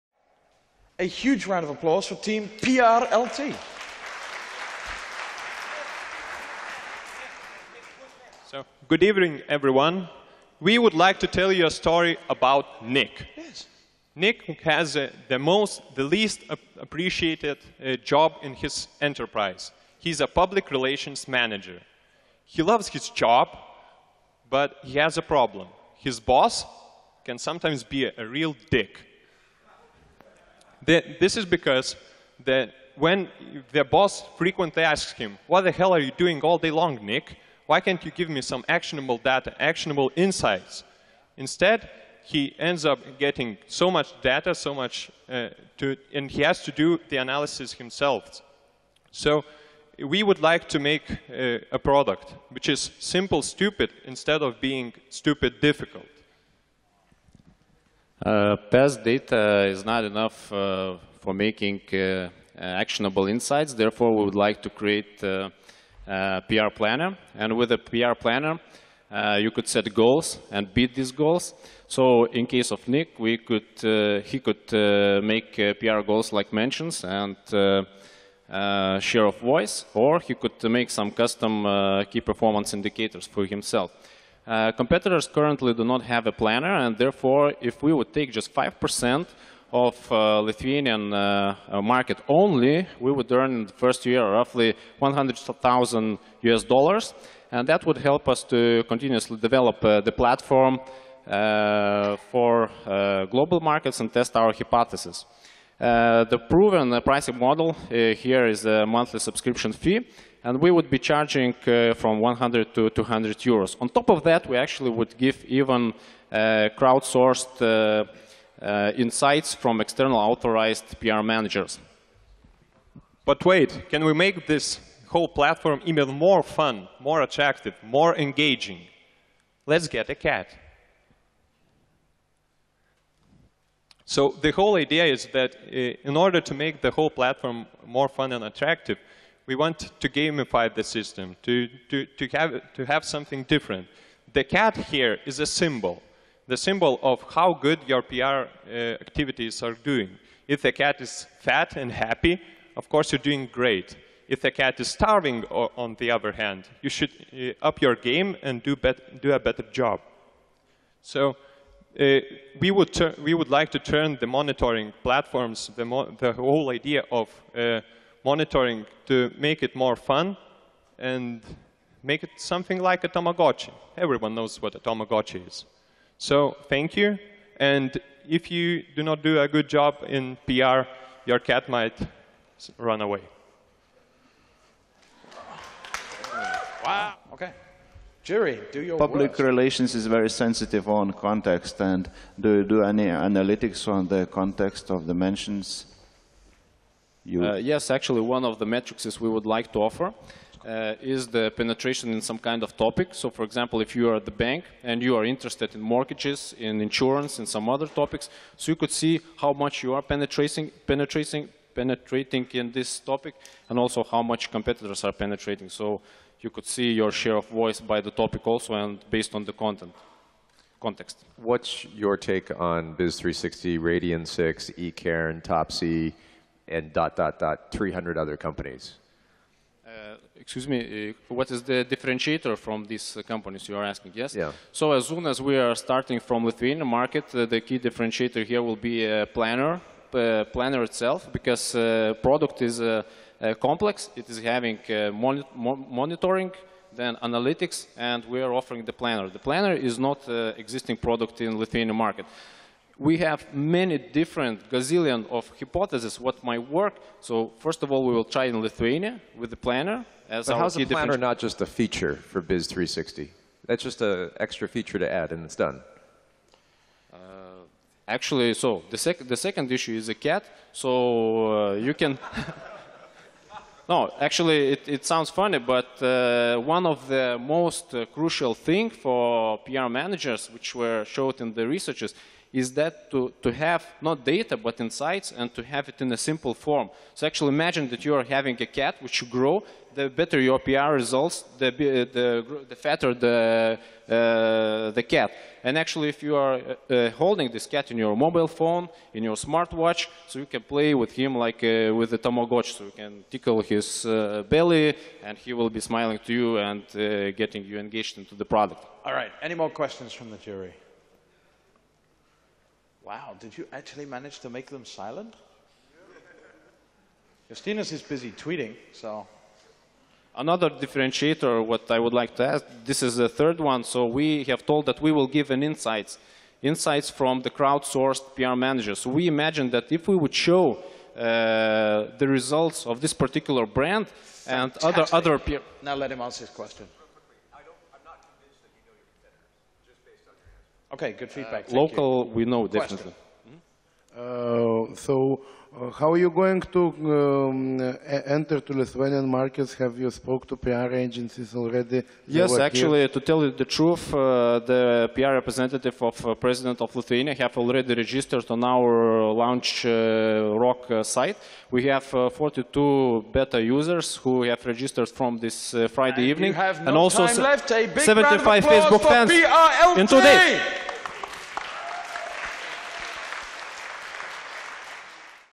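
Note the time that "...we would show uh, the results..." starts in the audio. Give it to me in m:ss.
5:30.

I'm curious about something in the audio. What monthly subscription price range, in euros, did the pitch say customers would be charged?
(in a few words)
100 to 200 euros.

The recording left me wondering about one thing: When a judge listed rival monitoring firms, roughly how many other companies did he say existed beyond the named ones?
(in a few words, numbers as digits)
300.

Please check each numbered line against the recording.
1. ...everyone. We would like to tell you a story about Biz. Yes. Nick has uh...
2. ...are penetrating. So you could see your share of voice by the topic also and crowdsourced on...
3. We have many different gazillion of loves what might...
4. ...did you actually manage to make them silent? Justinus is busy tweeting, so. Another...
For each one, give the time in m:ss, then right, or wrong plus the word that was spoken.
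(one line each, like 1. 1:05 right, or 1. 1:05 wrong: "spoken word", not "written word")
1. 0:09 wrong: "Nick", not "Biz"
2. 3:35 wrong: "based", not "crowdsourced"
3. 4:12 wrong: "hypotheses", not "loves"
4. 5:13 right.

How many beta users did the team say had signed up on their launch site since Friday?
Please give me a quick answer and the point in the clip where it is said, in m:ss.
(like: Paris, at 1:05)
42, at 6:02.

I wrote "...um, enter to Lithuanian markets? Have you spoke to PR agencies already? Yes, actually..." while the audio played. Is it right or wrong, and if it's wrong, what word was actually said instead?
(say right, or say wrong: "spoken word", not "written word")
right.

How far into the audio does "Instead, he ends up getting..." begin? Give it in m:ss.
0:41.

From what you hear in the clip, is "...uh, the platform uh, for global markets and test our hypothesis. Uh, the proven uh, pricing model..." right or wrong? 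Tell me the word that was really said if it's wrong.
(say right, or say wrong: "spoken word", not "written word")
right.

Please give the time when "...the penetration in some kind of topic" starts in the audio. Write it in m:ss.
3:21.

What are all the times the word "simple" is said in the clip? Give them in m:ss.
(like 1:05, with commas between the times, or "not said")
0:52, 4:46.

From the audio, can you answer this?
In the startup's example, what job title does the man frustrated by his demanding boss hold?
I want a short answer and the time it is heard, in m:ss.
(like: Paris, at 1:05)
public relations manager, at 0:20.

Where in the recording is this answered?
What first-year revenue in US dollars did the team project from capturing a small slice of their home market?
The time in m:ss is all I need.
1:34.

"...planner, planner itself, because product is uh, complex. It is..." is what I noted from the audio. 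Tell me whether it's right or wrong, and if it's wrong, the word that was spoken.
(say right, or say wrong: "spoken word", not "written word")
right.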